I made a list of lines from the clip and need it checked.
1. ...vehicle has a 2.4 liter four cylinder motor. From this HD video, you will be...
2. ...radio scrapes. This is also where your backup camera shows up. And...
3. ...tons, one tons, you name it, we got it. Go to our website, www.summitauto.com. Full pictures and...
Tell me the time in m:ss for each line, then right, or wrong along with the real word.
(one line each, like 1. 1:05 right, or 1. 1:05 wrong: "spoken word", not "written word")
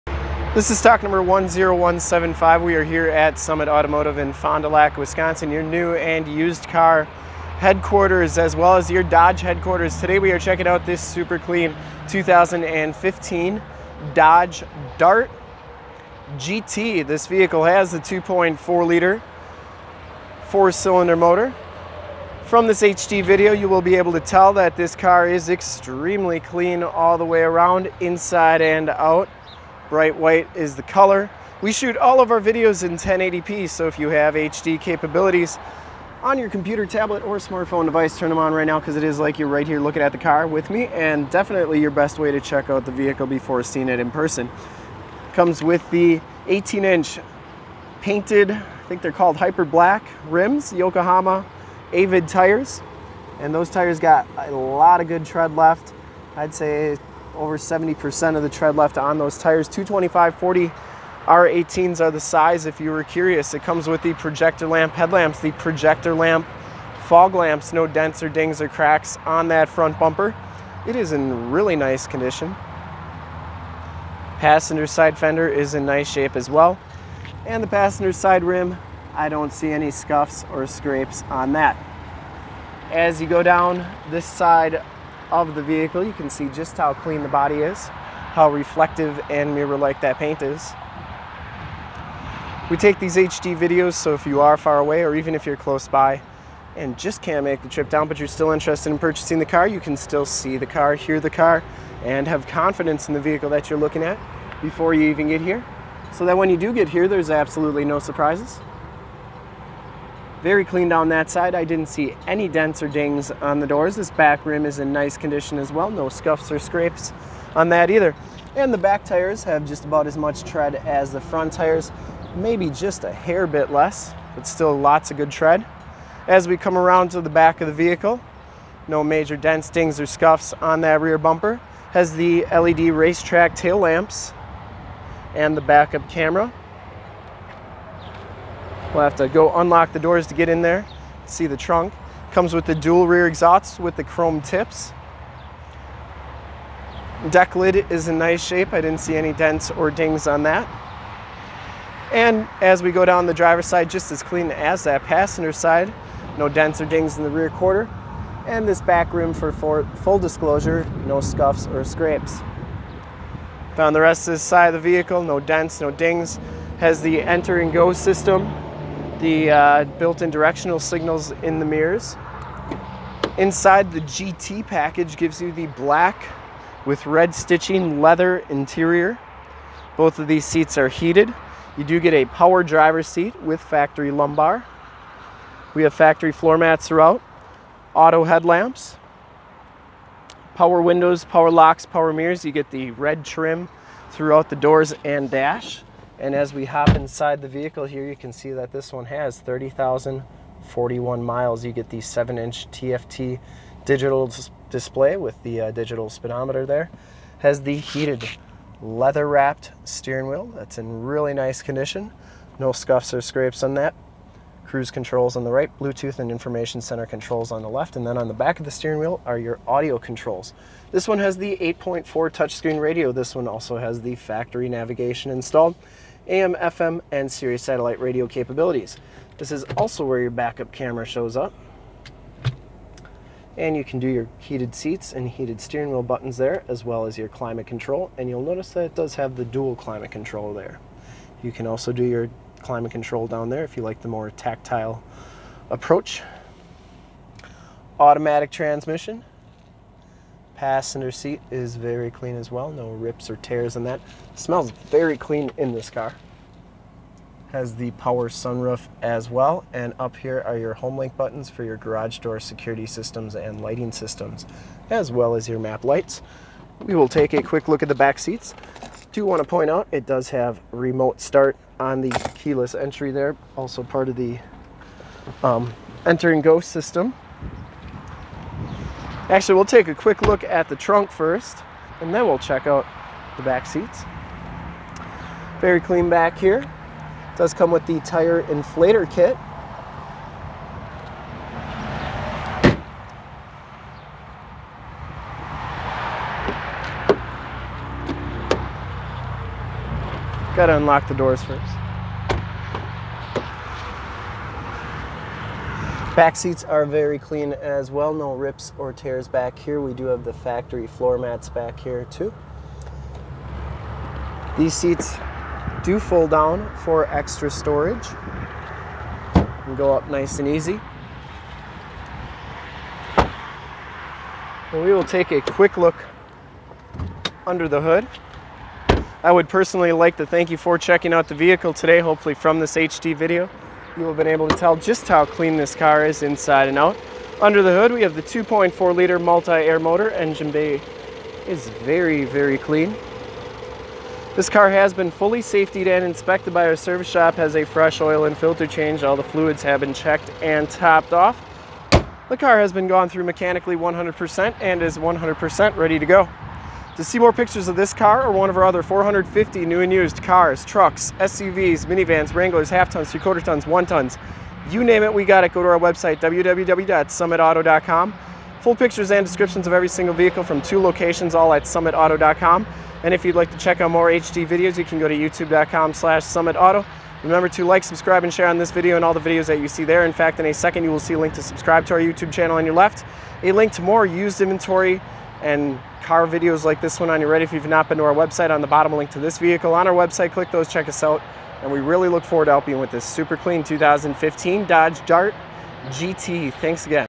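1. 0:17 right
2. 3:47 wrong: "capabilities", not "scrapes"
3. 6:03 right.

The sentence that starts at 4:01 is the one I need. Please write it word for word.
You can also do your climate control down there if you like the more tactile approach.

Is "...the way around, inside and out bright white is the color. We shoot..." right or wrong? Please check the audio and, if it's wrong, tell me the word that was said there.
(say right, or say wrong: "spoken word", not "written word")
right.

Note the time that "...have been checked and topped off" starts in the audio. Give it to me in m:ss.
5:49.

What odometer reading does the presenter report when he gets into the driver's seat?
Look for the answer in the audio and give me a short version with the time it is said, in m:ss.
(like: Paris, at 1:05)
30,041 miles, at 3:19.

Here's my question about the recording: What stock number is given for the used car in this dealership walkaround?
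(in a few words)
10175.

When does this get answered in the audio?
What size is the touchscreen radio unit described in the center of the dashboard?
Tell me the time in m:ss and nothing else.
3:41.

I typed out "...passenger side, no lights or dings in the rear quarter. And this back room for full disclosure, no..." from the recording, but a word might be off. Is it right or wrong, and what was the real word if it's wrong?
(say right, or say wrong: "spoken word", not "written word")
wrong: "dents", not "lights".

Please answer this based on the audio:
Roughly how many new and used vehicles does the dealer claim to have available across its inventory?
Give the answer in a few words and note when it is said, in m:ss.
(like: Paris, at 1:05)
450, at 5:58.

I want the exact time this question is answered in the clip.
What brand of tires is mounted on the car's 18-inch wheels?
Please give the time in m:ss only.
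0:50.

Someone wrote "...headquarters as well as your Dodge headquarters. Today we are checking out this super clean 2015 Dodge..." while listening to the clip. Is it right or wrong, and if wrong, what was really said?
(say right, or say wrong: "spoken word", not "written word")
right.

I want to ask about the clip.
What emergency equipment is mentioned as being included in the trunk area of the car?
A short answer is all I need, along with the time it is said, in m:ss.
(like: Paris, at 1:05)
tire inflator kit, at 4:48.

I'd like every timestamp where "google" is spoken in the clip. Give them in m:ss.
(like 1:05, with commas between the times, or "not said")
not said.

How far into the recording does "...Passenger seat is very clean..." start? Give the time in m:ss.
4:10.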